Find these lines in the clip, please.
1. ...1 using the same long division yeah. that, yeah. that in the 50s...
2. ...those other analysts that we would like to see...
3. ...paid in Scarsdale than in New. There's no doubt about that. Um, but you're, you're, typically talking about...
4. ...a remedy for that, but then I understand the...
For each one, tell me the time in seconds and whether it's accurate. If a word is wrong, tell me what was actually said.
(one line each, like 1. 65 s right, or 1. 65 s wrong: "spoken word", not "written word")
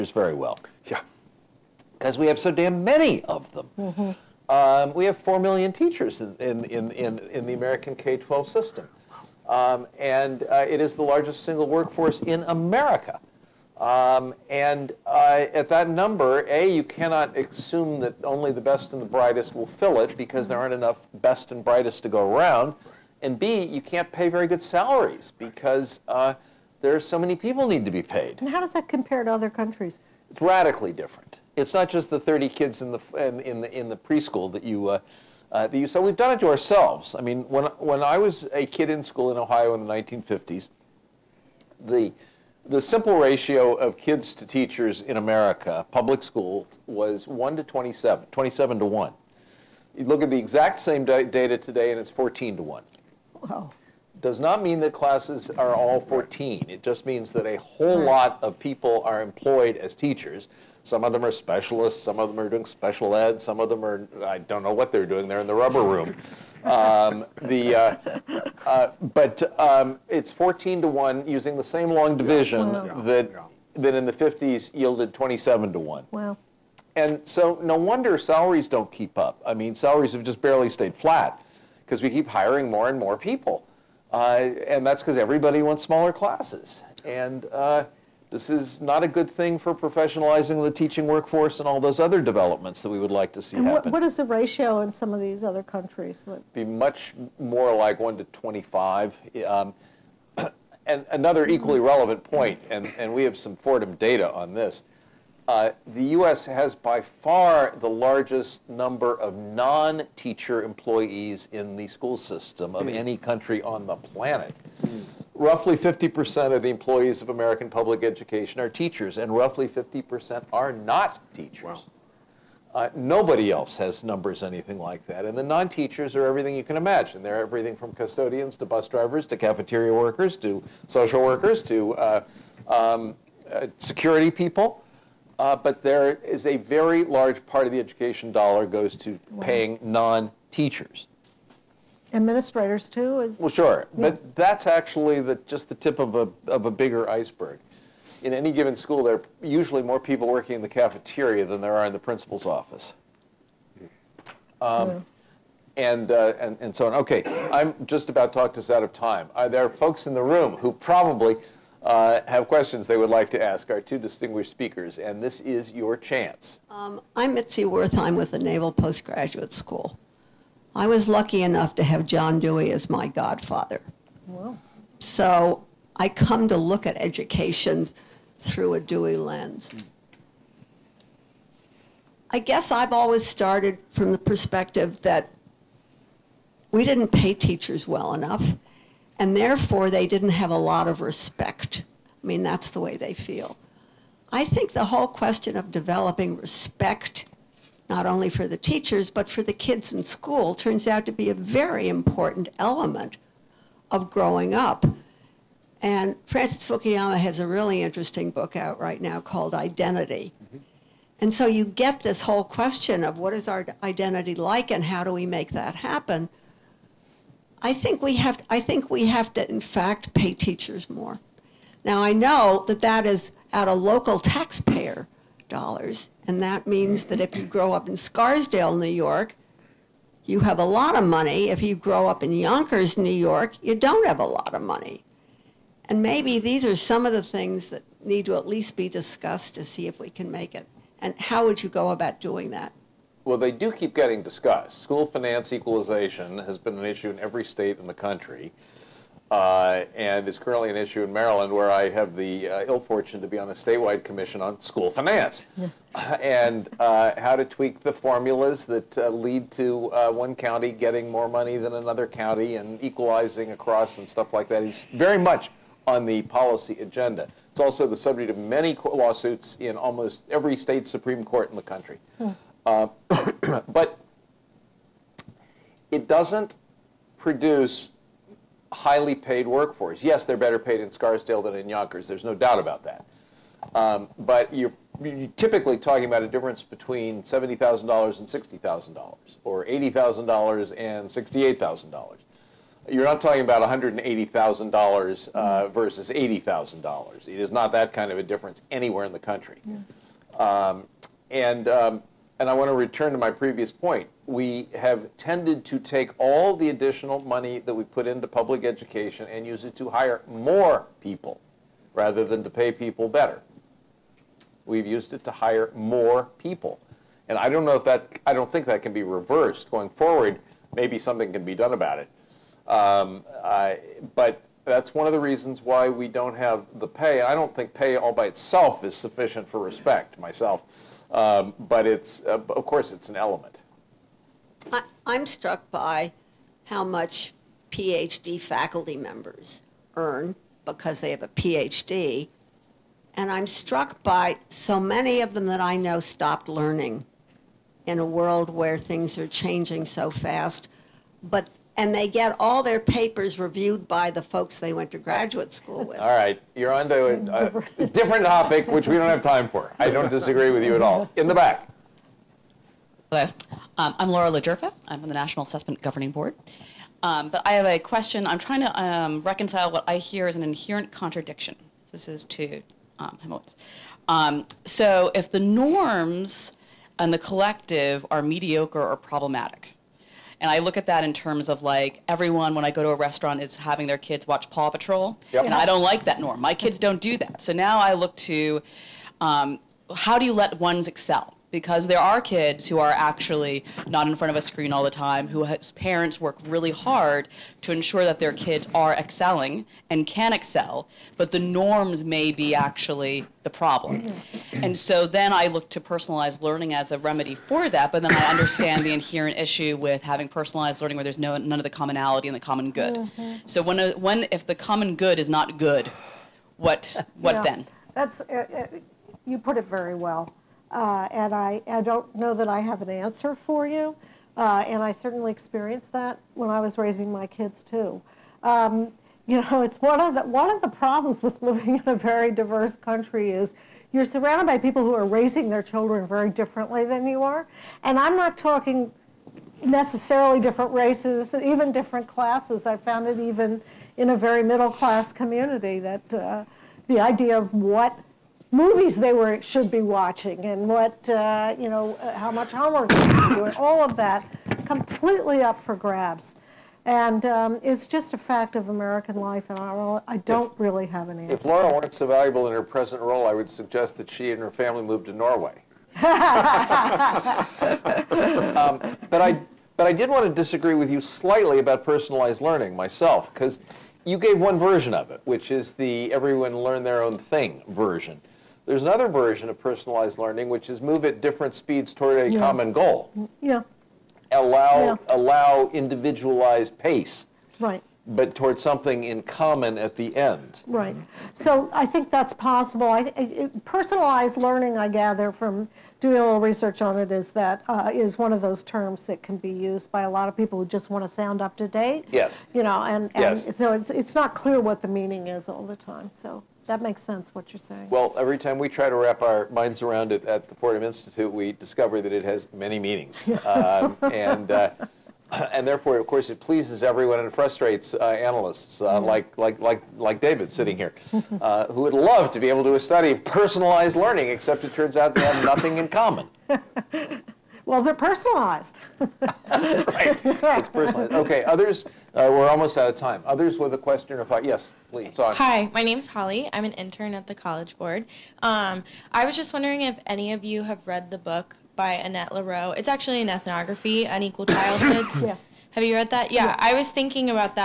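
1. 70 s right
2. 91 s wrong: "developments", not "analysts"
3. 280 s wrong: "Yonkers", not "New"
4. 406 s right.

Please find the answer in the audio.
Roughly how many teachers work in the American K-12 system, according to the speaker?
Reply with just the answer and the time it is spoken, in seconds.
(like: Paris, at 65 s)
4 million, at 5 s.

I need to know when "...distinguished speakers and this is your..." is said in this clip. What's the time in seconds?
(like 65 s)
163 s.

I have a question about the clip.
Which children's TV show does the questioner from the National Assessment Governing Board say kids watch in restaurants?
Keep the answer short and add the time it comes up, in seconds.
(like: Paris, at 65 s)
Paw Patrol, at 384 s.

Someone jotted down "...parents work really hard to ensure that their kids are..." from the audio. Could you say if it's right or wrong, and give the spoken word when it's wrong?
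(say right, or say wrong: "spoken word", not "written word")
right.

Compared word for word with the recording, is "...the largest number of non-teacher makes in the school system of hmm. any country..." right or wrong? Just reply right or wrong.
wrong.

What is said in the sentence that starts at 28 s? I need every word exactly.
And how does that compare to other countries?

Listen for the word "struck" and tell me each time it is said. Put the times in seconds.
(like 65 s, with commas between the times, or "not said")
335 s, 343 s.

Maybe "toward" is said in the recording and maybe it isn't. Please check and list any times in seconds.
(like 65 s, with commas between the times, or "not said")
481 s, 488 s.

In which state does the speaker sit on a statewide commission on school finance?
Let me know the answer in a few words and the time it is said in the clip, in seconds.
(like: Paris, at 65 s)
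Maryland, at 251 s.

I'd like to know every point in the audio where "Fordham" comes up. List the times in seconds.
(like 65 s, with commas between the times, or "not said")
103 s, 510 s.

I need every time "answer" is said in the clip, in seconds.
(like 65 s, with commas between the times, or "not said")
422 s, 461 s.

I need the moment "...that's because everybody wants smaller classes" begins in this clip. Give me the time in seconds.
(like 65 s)
84 s.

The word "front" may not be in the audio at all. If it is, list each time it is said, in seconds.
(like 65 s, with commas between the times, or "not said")
394 s.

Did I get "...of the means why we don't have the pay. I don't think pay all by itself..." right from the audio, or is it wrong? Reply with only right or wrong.
wrong.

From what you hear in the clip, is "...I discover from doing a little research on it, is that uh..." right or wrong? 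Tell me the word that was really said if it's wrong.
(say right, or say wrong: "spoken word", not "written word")
wrong: "gather", not "discover".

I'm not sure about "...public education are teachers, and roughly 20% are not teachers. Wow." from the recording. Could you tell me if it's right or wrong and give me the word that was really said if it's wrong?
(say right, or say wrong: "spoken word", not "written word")
wrong: "50", not "20".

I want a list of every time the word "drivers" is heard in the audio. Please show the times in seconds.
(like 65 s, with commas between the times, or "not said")
128 s.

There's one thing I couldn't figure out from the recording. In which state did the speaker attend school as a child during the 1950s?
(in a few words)
Ohio.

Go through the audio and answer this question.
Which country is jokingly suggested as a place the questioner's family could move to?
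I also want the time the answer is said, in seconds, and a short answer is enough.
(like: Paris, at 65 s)
Norway, at 465 s.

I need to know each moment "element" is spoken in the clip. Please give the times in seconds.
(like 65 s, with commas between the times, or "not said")
202 s, 333 s.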